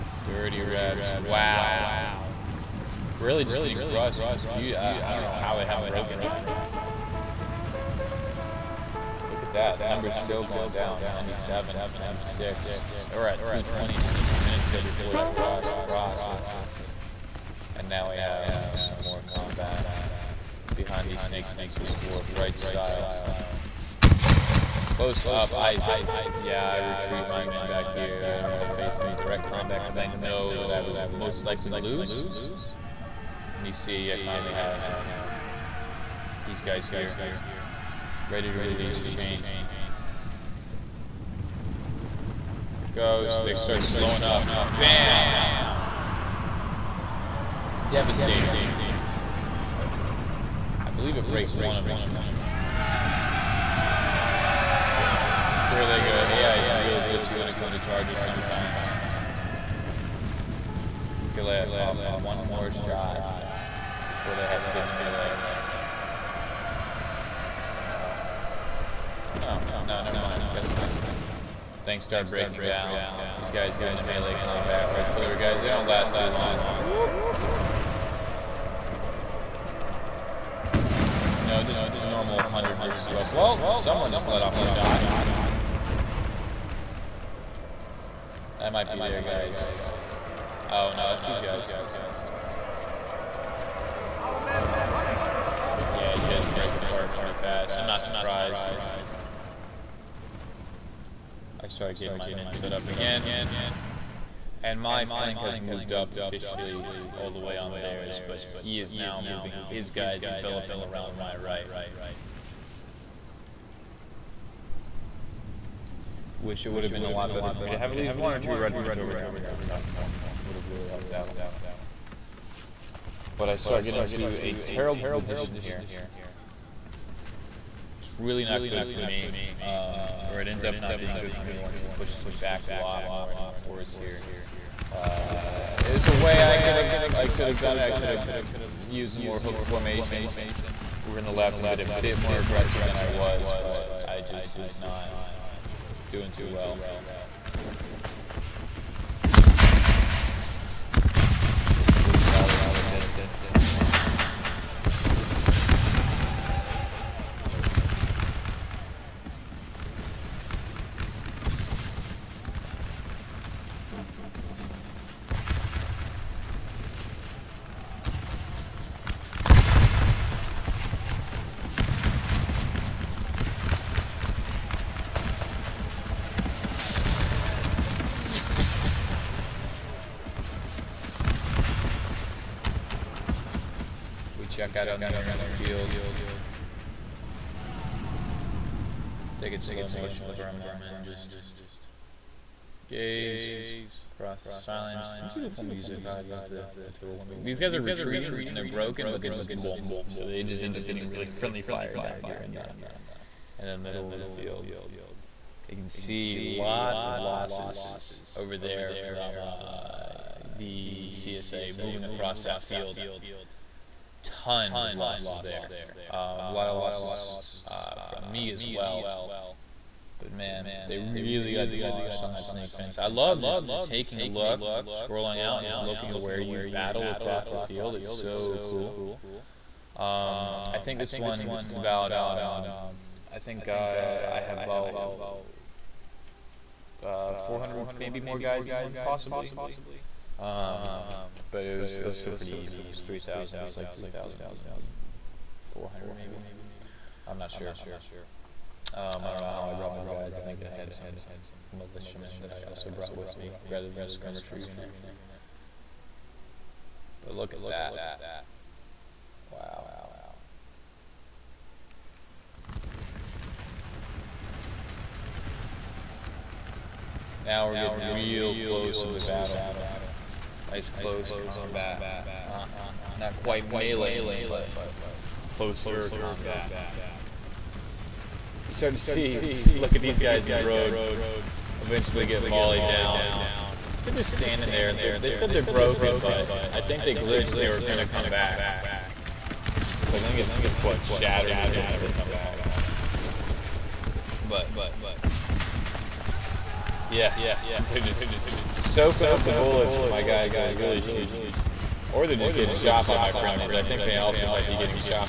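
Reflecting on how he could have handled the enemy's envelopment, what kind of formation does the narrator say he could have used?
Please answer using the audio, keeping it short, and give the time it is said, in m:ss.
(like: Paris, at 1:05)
hook formation, at 2:19.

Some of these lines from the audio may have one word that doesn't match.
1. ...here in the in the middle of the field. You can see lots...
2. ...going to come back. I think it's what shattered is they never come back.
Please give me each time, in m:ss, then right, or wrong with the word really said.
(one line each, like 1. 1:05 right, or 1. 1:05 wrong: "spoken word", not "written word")
1. 3:22 right
2. 4:47 right.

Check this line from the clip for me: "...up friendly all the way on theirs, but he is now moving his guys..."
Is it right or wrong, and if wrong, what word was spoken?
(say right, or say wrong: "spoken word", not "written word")
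wrong: "officially", not "friendly".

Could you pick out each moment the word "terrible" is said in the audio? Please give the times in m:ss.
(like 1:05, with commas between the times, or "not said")
2:04.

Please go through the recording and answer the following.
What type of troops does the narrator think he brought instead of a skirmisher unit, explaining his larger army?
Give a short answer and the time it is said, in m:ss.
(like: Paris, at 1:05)
militiamen, at 4:11.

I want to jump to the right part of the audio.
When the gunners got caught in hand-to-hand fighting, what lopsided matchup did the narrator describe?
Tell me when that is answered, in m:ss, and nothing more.
1:22.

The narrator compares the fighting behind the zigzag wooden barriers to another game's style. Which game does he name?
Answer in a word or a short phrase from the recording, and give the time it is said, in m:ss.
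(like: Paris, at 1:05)
War of Rights, at 0:22.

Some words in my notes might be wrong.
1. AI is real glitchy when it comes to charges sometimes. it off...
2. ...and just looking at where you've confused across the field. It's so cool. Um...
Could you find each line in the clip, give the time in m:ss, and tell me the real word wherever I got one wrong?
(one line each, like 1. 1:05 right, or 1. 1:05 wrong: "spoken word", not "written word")
1. 0:56 right
2. 3:45 wrong: "battled", not "confused".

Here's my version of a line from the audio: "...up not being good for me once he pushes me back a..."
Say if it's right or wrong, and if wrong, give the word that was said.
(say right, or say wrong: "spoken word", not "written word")
right.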